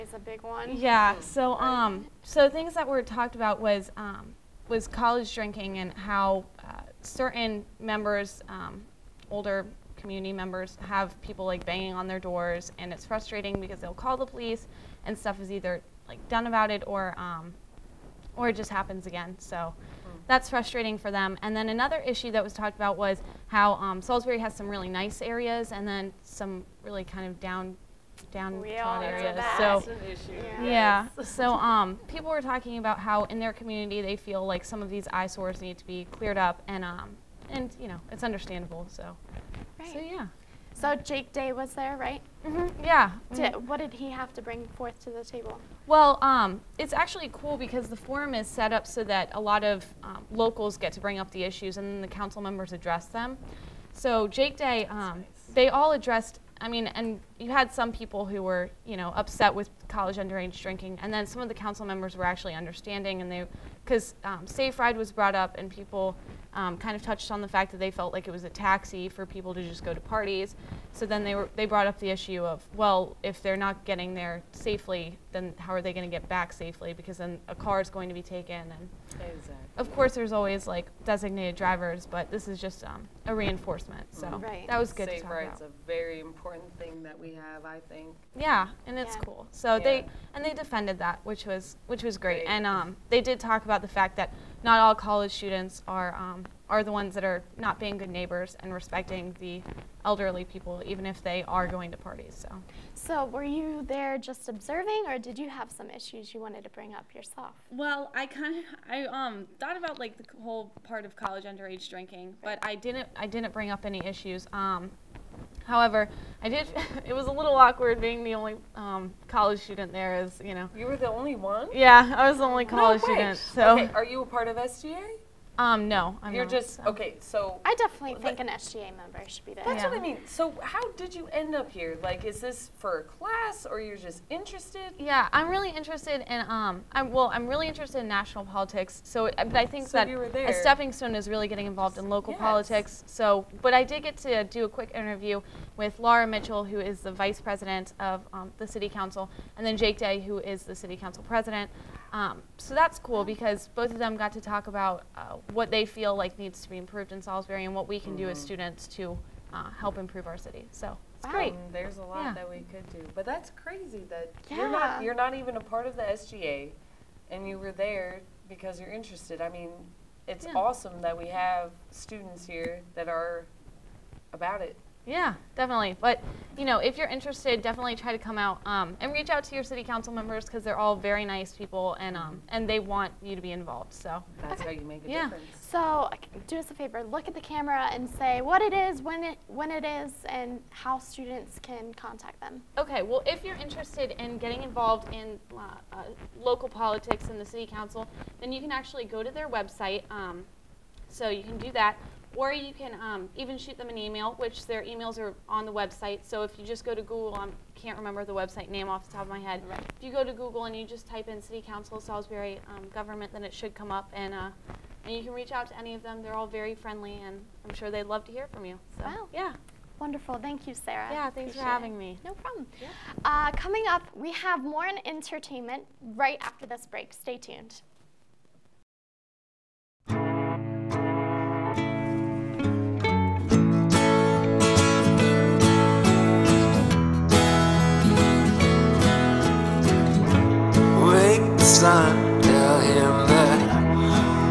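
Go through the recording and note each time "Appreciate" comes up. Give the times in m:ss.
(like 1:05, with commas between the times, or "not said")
3:41.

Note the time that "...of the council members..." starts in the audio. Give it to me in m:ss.
1:01.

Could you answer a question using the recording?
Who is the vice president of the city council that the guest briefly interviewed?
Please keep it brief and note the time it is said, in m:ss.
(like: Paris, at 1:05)
Laura Mitchell, at 2:25.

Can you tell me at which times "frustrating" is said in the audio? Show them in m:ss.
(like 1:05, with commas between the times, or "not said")
0:13, 0:20.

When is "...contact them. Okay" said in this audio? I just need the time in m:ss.
3:11.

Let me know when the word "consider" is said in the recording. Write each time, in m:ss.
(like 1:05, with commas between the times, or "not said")
not said.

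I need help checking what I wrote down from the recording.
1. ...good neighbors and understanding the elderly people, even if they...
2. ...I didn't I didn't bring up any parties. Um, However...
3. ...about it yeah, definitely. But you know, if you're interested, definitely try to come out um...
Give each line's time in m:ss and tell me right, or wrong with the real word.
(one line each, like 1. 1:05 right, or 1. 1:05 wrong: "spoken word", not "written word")
1. 1:37 wrong: "respecting", not "understanding"
2. 1:52 wrong: "issues", not "parties"
3. 2:54 right.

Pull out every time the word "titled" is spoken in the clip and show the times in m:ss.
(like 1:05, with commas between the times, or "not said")
not said.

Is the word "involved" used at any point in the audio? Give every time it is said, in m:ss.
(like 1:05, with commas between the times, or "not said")
2:21, 3:03, 3:14.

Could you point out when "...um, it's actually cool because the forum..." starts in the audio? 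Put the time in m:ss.
0:46.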